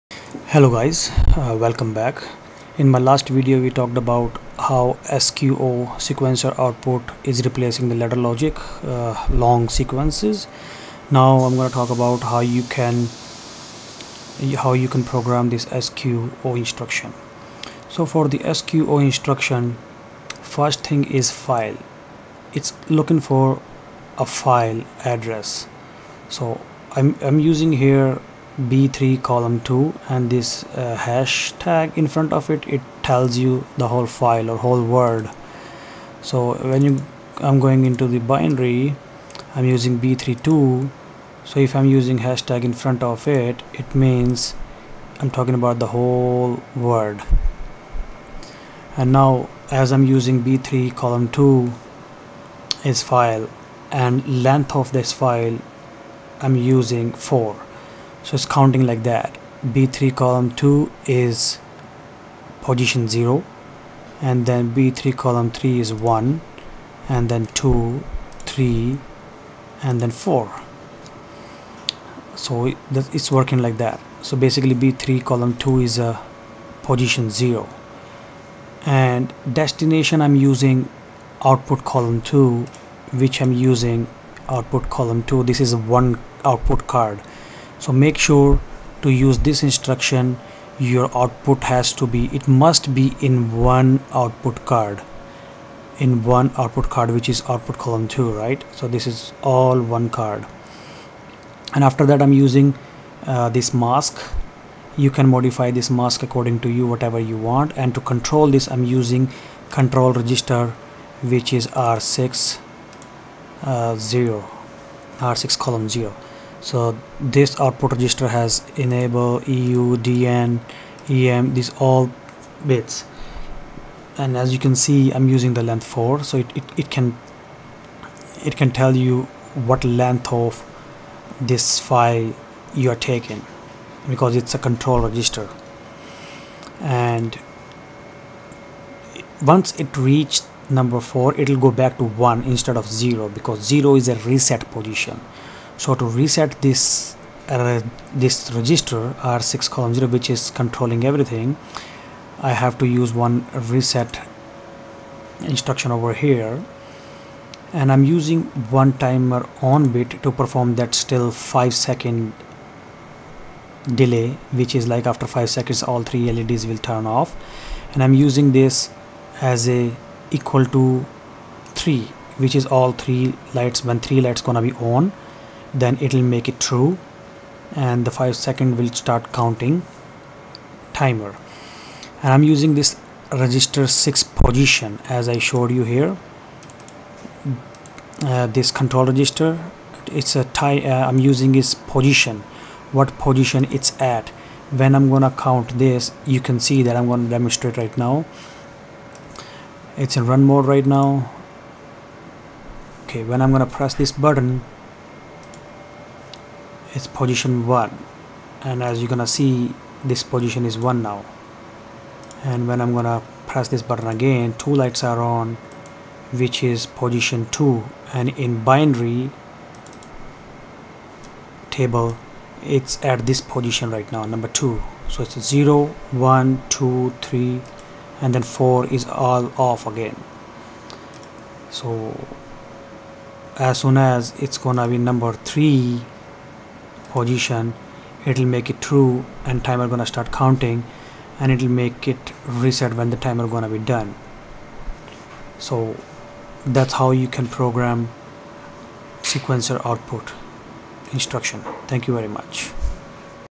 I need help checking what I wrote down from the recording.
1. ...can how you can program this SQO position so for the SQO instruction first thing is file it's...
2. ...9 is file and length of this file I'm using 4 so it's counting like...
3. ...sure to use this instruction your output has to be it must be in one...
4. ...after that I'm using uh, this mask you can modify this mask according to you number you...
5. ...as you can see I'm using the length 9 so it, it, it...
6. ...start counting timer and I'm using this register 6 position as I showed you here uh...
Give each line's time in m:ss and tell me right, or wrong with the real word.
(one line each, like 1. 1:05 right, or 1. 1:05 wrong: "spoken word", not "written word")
1. 0:12 wrong: "instruction", not "position"
2. 0:51 wrong: "2", not "9"
3. 1:28 right
4. 1:41 wrong: "whatever", not "number"
5. 2:04 wrong: "4", not "9"
6. 2:58 right.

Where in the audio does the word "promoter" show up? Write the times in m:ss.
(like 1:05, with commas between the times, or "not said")
not said.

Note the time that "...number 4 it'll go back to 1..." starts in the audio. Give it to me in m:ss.
2:20.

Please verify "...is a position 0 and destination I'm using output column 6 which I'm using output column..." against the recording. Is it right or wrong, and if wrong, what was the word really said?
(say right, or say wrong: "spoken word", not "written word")
wrong: "2", not "6".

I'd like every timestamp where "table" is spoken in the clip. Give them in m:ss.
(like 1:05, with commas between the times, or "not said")
3:41.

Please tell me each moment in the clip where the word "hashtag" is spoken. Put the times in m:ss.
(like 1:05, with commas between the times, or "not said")
0:30, 0:42.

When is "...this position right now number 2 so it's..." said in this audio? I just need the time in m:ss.
3:43.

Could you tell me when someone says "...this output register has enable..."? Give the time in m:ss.
1:57.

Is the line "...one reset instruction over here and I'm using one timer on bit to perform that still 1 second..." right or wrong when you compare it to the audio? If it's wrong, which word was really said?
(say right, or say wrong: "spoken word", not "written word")
wrong: "5", not "1".